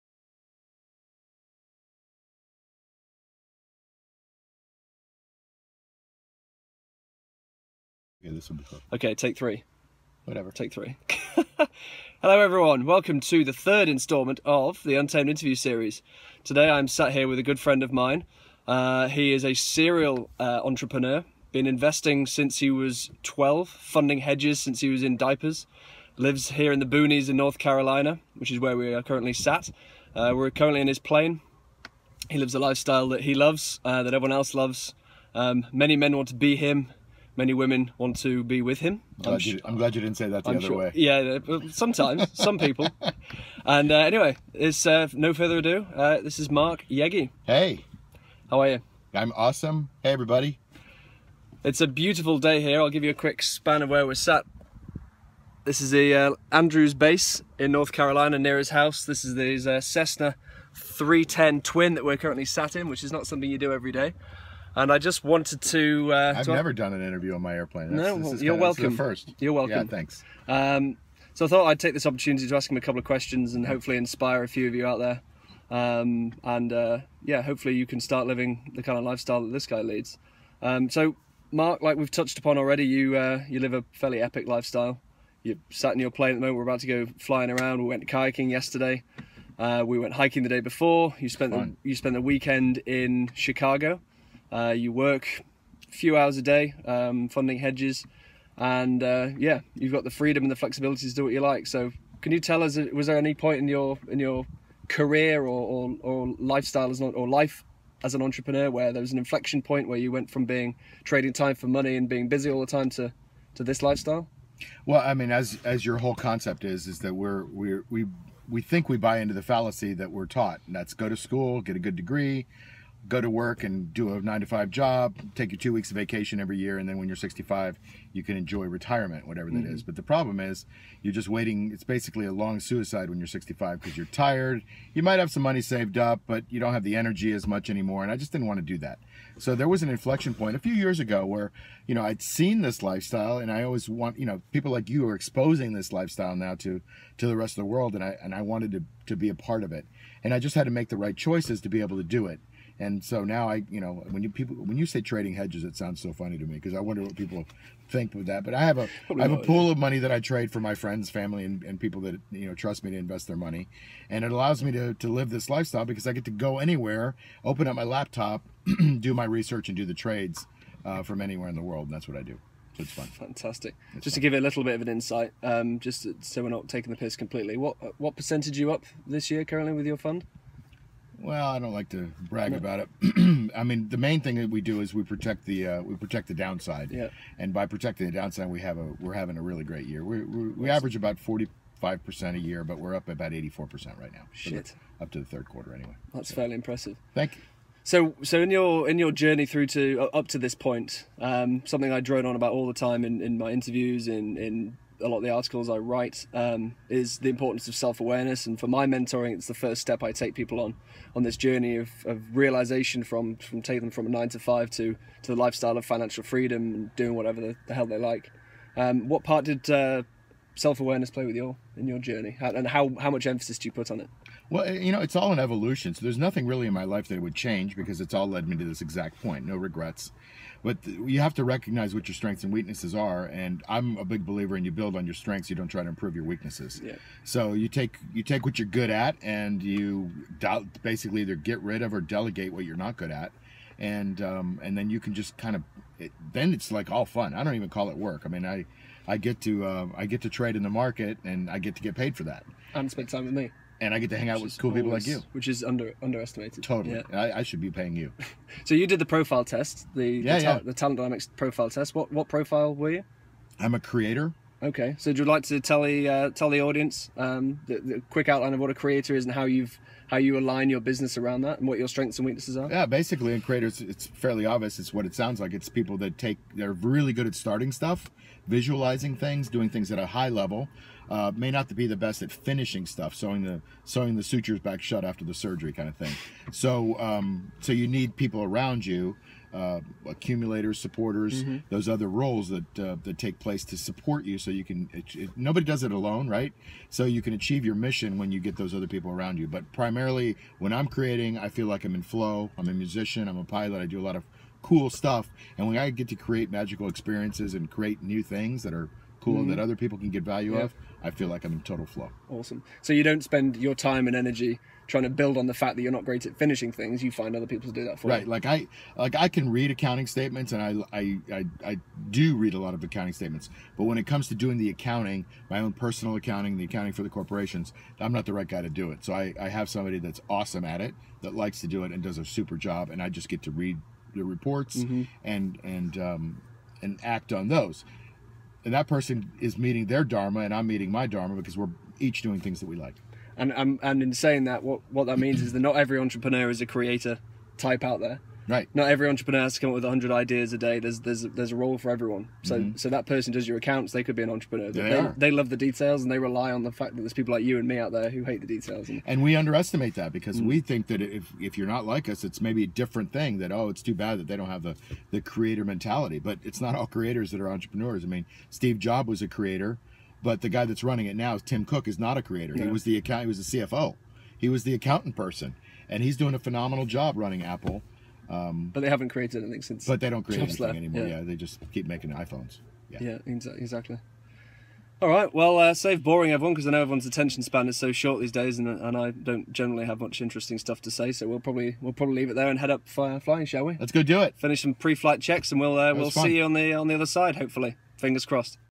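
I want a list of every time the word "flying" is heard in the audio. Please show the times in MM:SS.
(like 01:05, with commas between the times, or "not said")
01:27, 06:33.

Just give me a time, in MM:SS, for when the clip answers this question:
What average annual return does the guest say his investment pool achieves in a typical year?
03:11.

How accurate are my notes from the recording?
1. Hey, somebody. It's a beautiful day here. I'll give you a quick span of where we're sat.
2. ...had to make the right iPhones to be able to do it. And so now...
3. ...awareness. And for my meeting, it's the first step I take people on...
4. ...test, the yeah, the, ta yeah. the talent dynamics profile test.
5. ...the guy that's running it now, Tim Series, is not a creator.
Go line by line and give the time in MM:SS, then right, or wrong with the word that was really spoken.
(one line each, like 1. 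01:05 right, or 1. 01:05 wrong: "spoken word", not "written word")
1. 00:50 wrong: "everybody", not "somebody"
2. 02:30 wrong: "choices", not "iPhones"
3. 03:27 wrong: "mentoring", not "meeting"
4. 04:19 right
5. 06:10 wrong: "Cook", not "Series".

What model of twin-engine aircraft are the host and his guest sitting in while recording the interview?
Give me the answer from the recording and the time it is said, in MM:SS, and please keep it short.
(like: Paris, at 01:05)
Cessna 310, at 00:59.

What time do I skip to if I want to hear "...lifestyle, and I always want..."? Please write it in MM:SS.
02:22.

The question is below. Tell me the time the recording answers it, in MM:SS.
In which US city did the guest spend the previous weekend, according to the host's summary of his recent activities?
01:33.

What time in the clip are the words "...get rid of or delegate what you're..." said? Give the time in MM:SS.
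04:01.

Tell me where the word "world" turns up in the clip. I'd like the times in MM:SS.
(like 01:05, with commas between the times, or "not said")
02:27, 02:51.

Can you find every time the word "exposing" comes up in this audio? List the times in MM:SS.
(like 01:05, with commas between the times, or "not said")
02:25.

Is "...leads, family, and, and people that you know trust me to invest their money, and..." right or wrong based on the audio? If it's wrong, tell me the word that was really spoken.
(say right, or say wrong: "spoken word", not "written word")
wrong: "friends", not "leads".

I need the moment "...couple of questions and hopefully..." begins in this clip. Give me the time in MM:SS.
01:12.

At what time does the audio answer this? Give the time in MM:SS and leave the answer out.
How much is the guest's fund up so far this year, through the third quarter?
03:13.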